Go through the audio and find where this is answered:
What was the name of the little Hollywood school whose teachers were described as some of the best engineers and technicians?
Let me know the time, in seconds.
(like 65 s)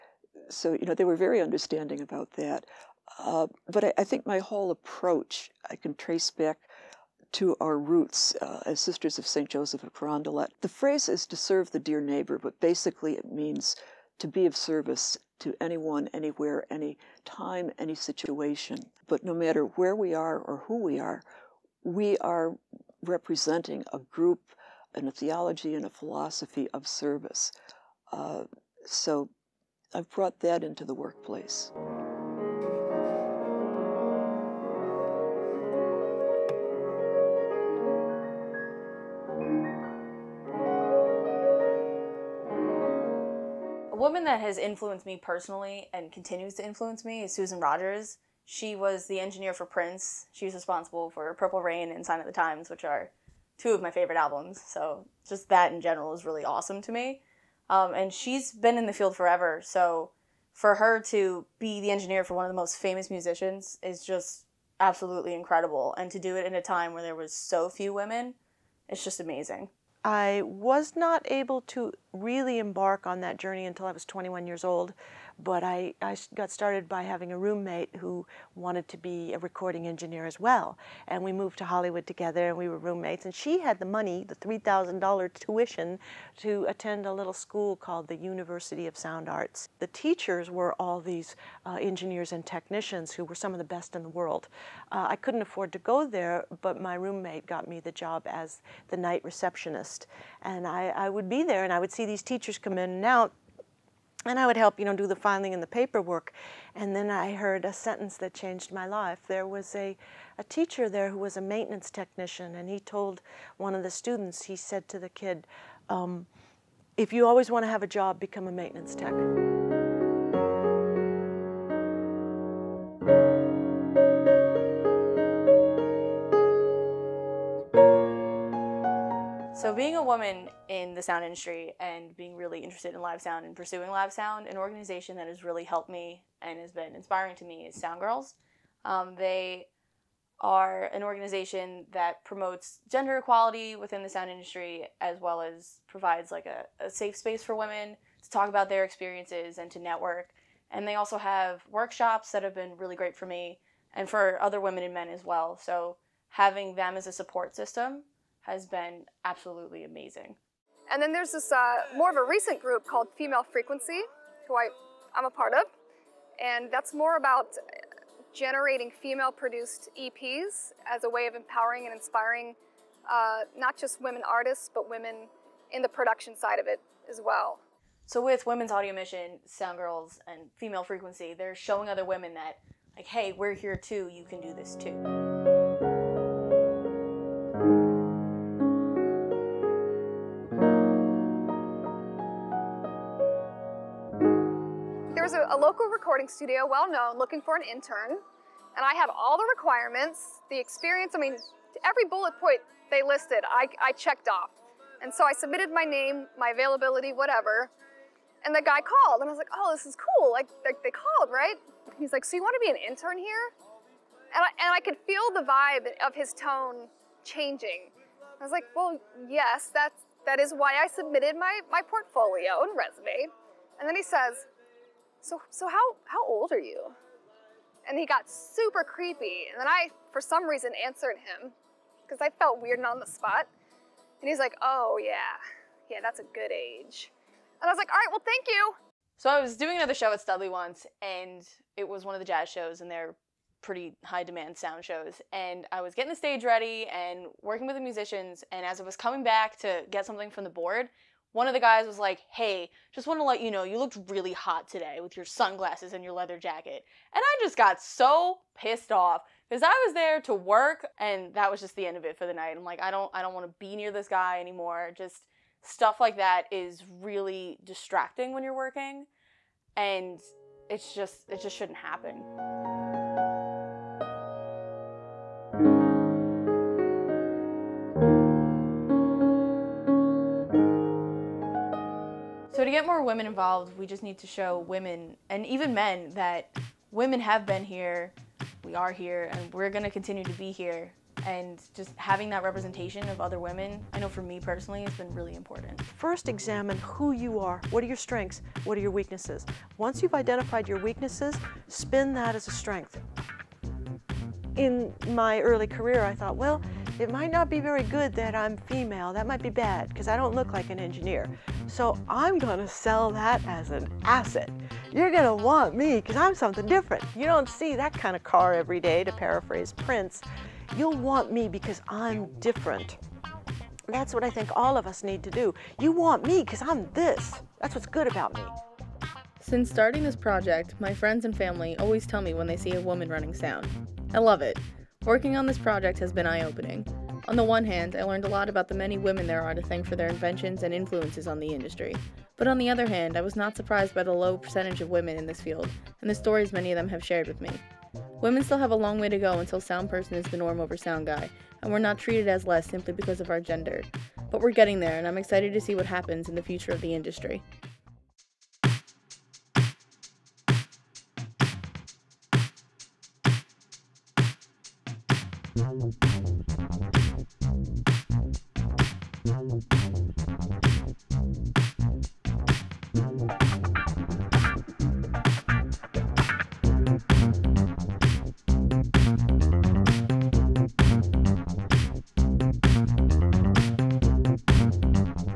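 88 s.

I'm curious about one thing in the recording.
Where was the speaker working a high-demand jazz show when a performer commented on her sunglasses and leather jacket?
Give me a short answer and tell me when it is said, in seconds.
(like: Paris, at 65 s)
Studley, at 240 s.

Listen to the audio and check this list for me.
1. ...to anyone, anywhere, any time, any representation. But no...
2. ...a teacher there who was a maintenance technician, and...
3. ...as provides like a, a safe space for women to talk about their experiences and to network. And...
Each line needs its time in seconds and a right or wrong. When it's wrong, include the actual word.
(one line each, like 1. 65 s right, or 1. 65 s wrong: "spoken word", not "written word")
1. 15 s wrong: "situation", not "representation"
2. 110 s right
3. 145 s right.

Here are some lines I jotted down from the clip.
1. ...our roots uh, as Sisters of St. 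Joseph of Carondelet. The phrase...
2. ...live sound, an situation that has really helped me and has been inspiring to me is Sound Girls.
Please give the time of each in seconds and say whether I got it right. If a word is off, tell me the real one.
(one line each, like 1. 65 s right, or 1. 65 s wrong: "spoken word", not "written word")
1. 7 s right
2. 133 s wrong: "organization", not "situation".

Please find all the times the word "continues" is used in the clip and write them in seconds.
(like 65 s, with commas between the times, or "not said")
46 s, 289 s.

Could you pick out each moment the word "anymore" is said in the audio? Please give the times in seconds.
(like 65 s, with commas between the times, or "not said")
264 s.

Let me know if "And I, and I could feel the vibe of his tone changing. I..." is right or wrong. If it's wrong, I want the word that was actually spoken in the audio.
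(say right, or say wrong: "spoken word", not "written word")
right.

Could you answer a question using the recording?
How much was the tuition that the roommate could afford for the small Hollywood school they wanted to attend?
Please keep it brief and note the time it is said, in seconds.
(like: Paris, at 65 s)
$3,000, at 84 s.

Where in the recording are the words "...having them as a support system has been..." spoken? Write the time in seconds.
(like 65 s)
156 s.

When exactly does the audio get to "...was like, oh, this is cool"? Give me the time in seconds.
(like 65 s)
209 s.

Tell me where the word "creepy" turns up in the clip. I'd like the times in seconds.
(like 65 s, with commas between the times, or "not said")
228 s.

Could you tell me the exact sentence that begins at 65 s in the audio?
And to do it in a time where there was so few women, it's just amazing.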